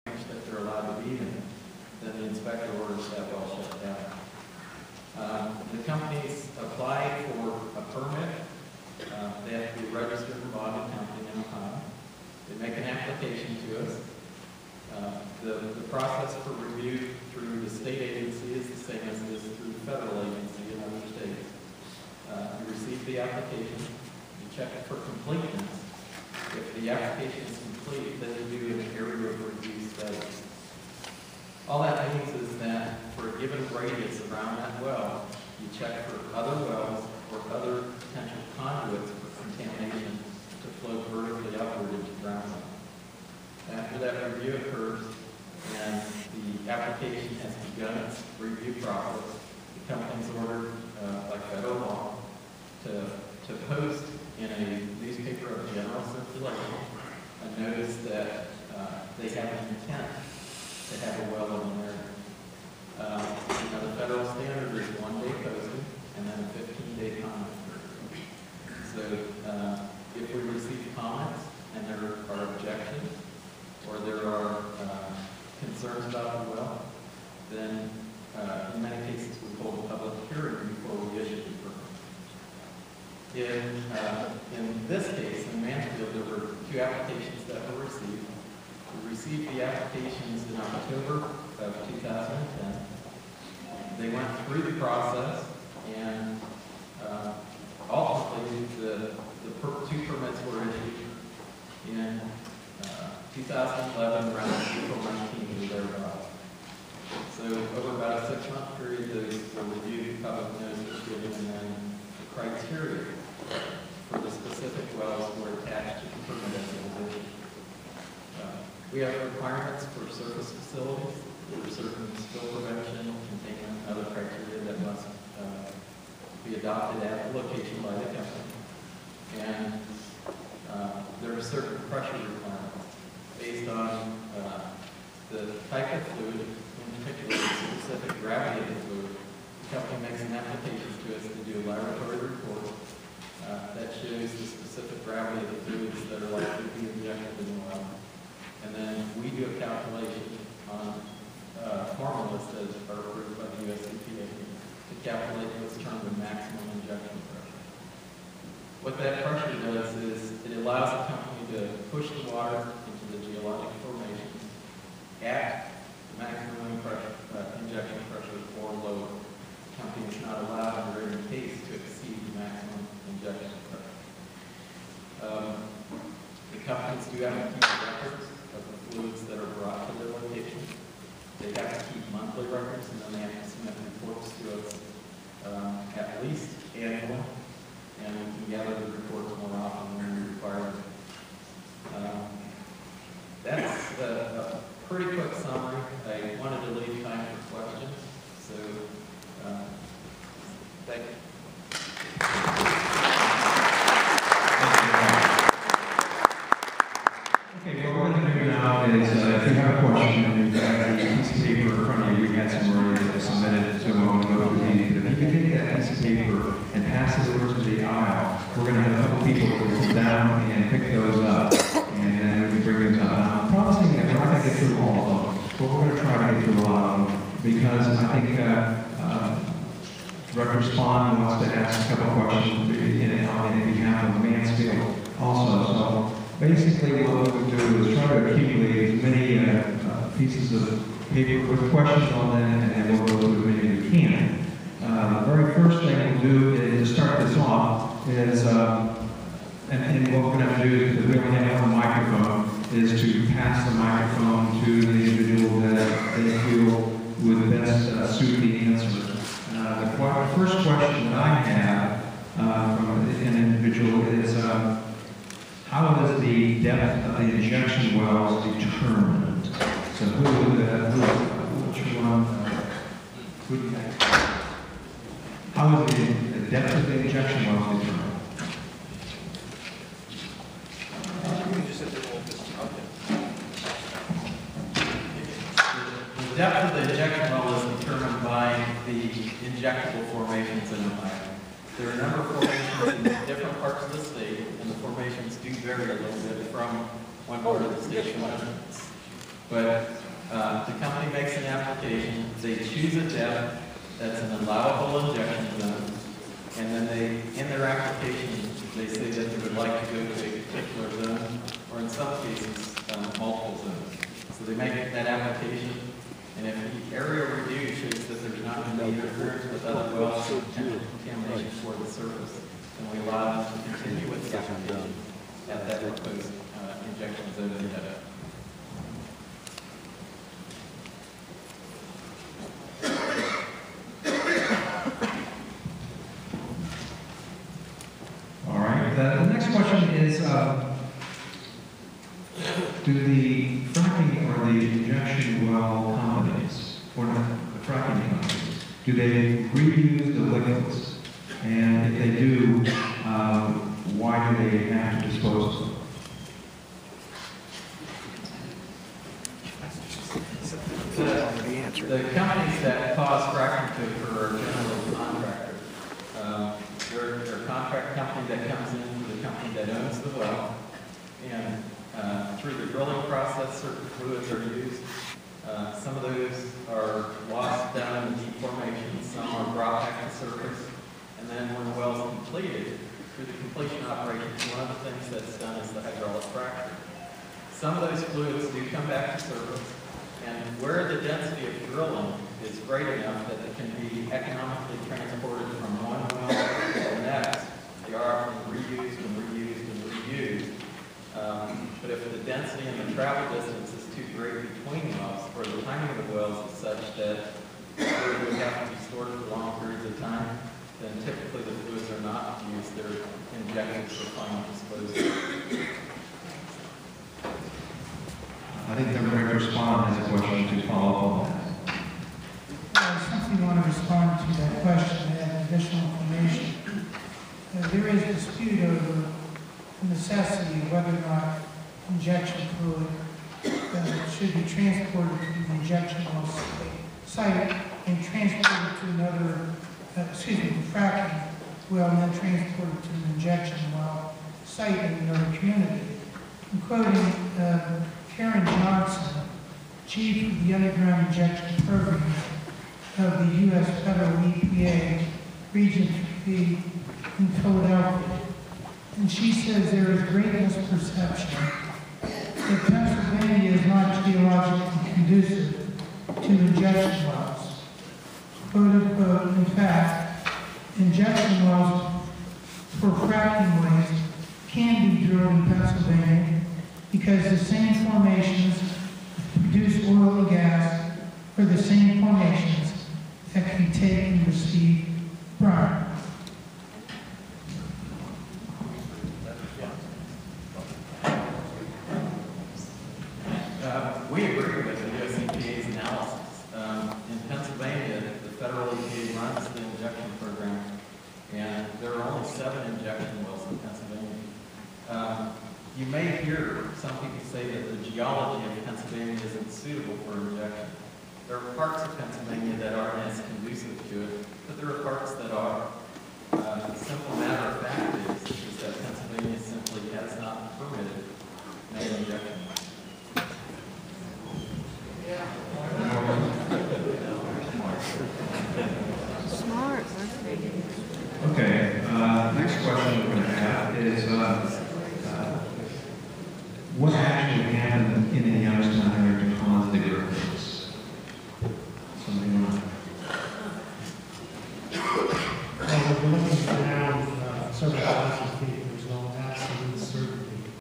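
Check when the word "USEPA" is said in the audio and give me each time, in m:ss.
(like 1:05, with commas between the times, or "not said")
8:15.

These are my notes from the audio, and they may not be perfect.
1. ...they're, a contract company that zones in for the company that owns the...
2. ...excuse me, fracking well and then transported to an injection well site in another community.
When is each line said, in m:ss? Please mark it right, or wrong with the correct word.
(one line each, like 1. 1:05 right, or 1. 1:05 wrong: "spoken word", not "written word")
1. 6:07 wrong: "comes", not "zones"
2. 7:20 right.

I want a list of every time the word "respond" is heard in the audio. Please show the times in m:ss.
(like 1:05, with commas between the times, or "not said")
6:59, 7:03.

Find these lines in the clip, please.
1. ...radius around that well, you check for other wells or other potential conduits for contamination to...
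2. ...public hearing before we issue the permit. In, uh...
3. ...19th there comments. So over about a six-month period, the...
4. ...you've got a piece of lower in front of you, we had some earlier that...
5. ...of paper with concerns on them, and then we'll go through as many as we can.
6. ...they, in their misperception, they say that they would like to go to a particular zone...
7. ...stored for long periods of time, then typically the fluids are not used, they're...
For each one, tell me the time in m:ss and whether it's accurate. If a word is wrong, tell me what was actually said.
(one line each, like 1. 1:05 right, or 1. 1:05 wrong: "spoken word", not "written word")
1. 0:33 right
2. 1:19 right
3. 1:45 wrong: "thereabouts", not "comments"
4. 3:30 wrong: "paper", not "lower"
5. 4:00 wrong: "questions", not "concerns"
6. 5:06 wrong: "application", not "misperception"
7. 6:48 right.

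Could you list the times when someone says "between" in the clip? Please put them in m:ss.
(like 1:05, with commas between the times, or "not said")
6:44.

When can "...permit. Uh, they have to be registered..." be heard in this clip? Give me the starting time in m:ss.
0:07.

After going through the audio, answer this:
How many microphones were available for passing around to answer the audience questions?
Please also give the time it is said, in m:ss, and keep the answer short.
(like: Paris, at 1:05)
1, at 4:11.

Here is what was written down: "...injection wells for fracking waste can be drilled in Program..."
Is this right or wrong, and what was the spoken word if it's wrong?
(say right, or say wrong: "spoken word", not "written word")
wrong: "Pennsylvania", not "Program".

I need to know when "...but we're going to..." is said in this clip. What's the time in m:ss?
3:45.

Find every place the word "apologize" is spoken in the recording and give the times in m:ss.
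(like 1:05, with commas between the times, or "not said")
not said.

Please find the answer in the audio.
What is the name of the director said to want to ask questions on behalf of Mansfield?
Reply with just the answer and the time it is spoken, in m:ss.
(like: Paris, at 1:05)
Spahn, at 3:50.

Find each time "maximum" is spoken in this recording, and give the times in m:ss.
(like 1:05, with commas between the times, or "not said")
2:36, 2:46.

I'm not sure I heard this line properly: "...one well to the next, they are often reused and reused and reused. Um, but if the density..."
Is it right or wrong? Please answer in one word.
right.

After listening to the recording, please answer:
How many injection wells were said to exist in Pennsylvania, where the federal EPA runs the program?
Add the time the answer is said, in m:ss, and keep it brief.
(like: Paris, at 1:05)
7, at 8:22.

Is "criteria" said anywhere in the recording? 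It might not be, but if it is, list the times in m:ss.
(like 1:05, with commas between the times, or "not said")
1:52, 2:04.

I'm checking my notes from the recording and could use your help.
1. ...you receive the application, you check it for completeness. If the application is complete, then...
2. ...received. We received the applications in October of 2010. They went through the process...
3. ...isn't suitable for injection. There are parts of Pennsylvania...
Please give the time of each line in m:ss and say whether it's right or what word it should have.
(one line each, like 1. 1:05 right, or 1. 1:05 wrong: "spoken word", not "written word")
1. 0:22 right
2. 1:27 right
3. 8:29 right.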